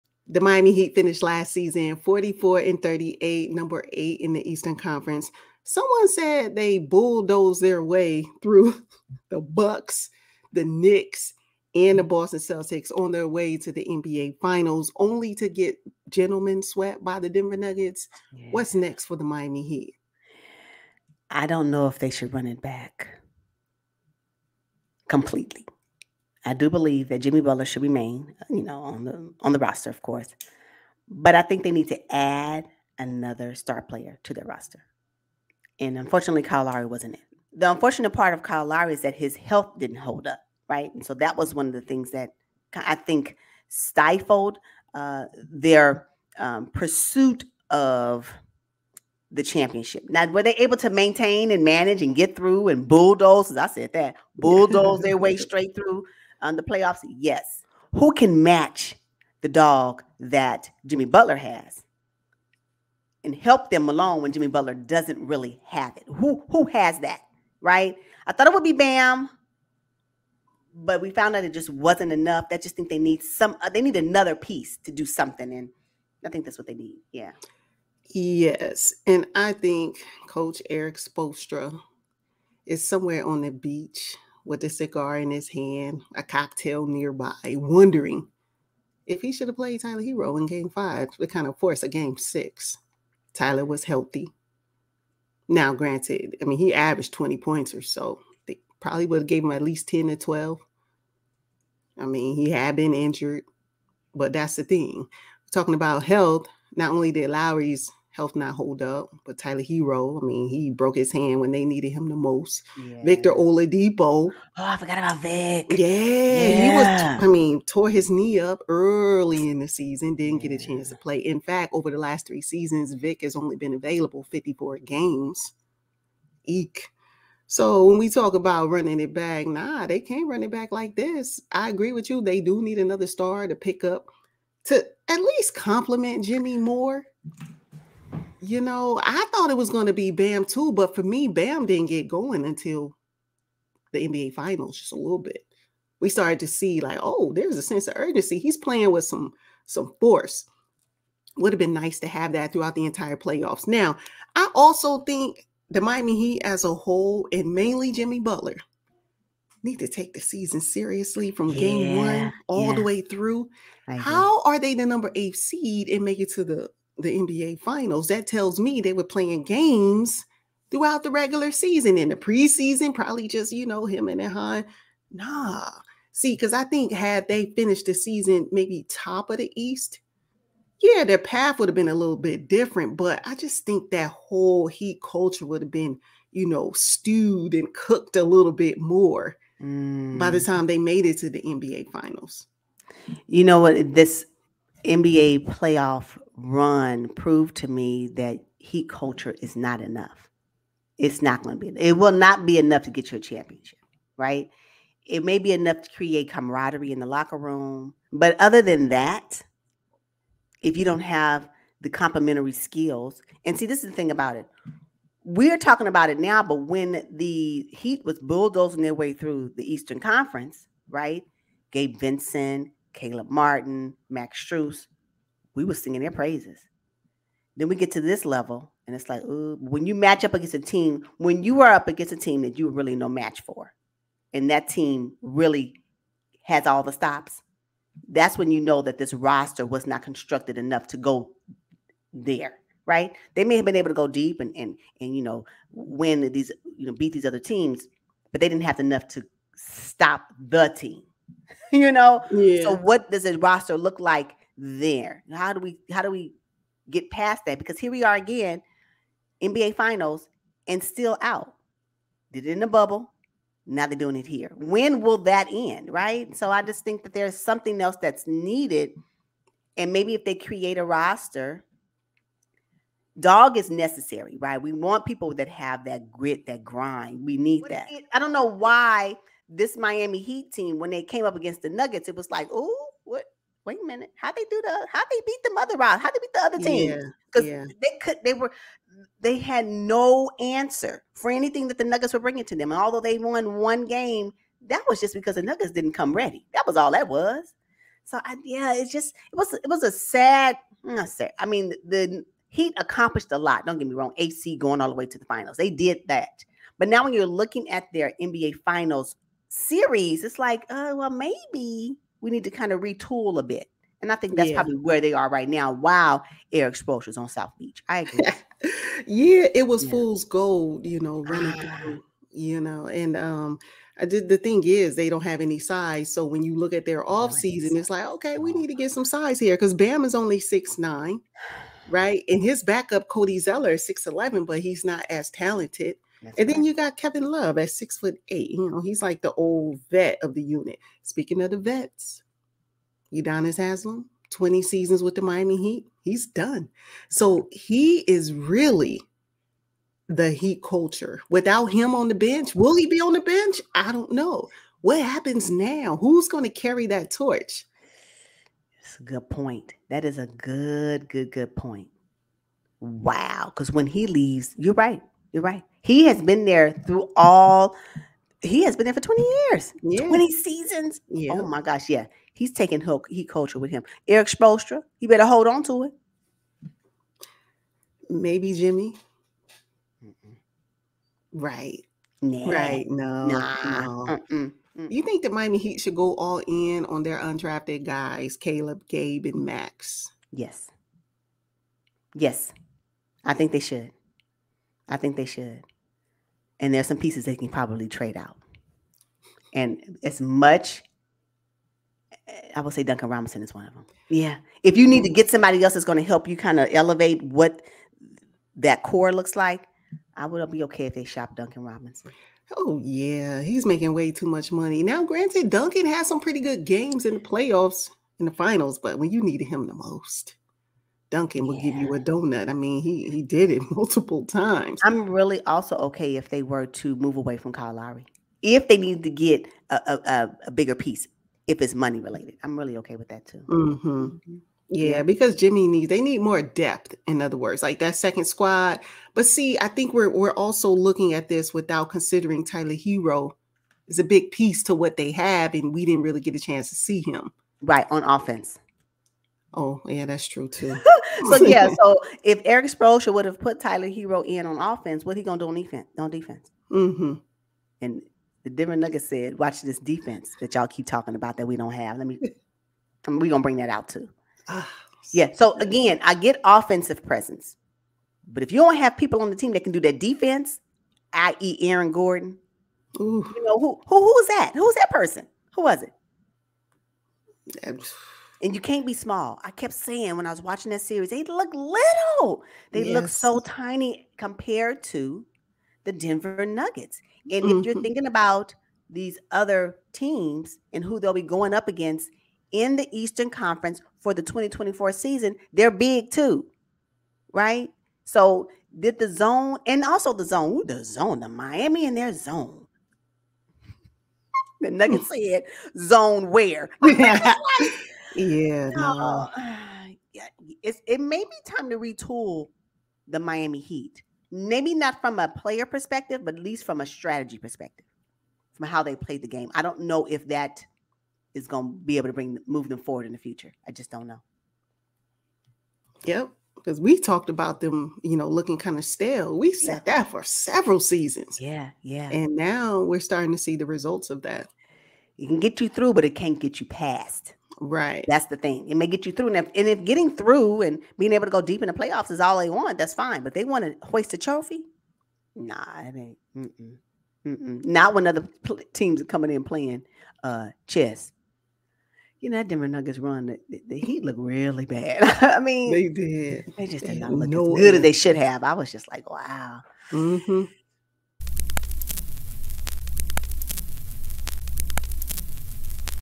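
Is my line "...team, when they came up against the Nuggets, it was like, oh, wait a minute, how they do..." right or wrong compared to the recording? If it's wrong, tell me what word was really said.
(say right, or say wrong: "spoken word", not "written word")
right.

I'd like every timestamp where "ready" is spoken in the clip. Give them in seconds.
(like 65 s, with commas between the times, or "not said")
296 s.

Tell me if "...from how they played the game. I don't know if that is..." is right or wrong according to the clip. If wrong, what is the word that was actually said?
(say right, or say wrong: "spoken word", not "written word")
right.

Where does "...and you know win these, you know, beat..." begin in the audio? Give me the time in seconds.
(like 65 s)
245 s.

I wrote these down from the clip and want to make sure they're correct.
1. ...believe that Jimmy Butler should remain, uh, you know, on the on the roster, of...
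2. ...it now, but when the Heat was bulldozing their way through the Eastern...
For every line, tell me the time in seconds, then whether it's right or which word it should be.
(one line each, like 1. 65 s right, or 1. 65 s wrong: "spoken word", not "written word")
1. 26 s right
2. 216 s right.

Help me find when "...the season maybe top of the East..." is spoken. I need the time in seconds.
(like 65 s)
177 s.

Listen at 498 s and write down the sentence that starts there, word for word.
So did the zone and also the zone, ooh, the zone, the Miami and their zone.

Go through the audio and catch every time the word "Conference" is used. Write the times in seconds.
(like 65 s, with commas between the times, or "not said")
4 s, 219 s, 493 s.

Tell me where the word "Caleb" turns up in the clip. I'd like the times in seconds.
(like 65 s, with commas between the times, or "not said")
222 s, 388 s.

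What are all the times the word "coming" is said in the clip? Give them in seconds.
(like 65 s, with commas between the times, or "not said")
549 s.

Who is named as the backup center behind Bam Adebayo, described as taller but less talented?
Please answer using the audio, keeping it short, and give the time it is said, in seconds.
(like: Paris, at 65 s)
Cody Zeller, at 333 s.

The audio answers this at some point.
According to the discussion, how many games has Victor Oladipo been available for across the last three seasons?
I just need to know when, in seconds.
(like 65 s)
124 s.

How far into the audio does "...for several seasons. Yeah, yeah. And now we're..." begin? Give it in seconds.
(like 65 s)
530 s.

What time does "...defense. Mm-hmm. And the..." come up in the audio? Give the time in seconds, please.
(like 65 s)
456 s.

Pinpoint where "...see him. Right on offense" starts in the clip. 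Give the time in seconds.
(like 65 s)
446 s.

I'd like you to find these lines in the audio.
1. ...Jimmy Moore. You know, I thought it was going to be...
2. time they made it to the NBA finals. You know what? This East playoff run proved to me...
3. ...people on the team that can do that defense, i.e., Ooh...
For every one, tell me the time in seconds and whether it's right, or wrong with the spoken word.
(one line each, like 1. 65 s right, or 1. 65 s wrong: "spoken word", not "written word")
1. 136 s right
2. 190 s wrong: "NBA", not "East"
3. 468 s wrong: "Aaron", not "Ooh".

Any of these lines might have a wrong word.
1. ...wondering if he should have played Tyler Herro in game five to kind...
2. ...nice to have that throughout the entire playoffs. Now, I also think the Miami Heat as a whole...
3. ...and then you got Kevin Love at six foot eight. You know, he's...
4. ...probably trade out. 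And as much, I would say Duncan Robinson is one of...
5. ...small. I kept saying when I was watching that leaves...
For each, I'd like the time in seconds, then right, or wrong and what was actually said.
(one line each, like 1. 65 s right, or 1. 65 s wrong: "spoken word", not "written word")
1. 87 s right
2. 151 s right
3. 336 s right
4. 397 s right
5. 478 s wrong: "series", not "leaves".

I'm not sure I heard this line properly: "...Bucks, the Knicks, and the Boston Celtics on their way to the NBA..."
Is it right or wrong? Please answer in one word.
right.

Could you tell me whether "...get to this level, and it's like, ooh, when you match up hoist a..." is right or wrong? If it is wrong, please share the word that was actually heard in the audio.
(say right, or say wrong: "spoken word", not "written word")
wrong: "against", not "hoist".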